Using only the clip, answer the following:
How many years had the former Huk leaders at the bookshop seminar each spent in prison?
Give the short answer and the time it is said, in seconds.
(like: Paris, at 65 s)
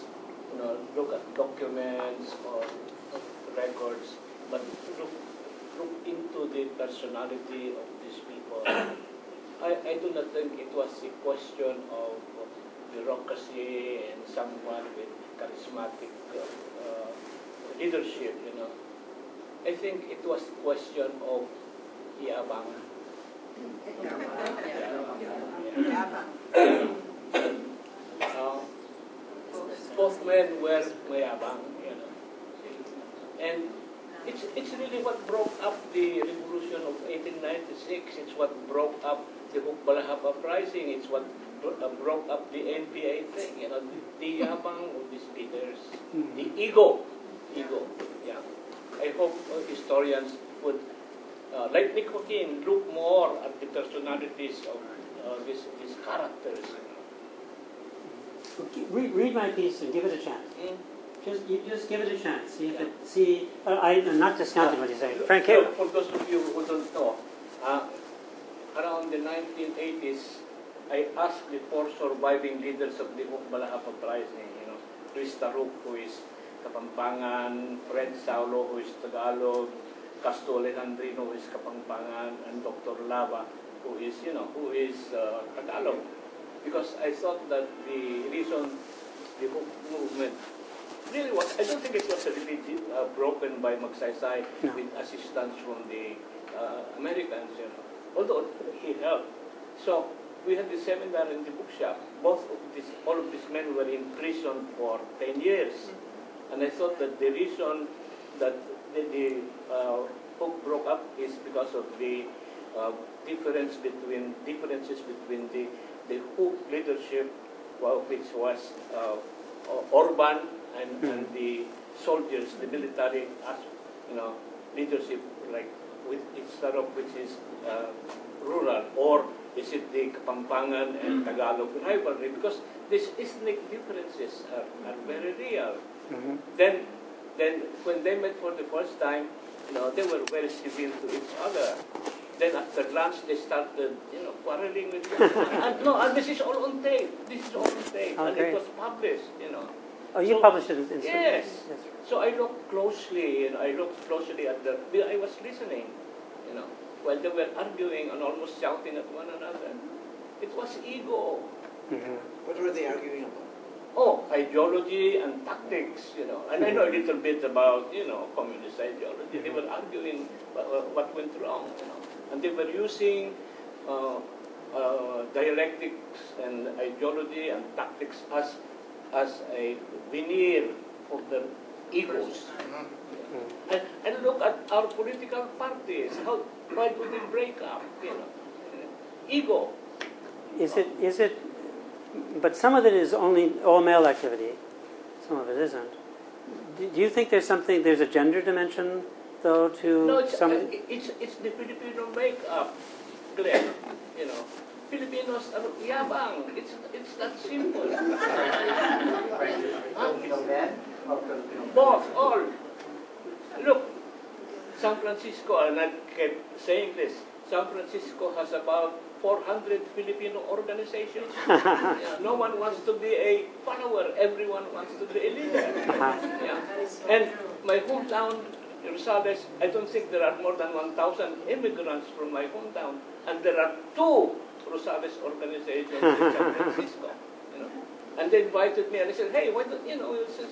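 10, at 105 s.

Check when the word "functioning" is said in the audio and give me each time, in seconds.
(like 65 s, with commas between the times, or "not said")
not said.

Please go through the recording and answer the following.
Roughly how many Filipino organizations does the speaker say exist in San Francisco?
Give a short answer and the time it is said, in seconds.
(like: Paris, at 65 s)
400, at 219 s.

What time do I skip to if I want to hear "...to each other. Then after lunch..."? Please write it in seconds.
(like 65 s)
141 s.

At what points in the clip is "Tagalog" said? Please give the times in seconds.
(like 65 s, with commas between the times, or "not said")
79 s, 85 s, 131 s.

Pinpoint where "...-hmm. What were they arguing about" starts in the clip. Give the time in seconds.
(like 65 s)
162 s.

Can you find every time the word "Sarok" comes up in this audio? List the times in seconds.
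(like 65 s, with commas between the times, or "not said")
126 s.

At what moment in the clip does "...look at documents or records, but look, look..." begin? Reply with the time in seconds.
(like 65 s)
0 s.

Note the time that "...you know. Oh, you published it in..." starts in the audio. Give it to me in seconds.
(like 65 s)
149 s.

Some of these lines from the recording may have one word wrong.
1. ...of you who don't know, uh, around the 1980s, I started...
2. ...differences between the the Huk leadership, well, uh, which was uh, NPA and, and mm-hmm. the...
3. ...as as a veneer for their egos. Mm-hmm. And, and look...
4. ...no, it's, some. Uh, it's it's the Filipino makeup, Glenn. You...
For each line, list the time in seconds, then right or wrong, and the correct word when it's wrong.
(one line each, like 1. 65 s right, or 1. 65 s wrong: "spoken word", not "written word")
1. 66 s wrong: "asked", not "started"
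2. 114 s wrong: "Orban", not "NPA"
3. 178 s right
4. 200 s right.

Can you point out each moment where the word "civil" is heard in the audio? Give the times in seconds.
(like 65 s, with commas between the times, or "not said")
140 s.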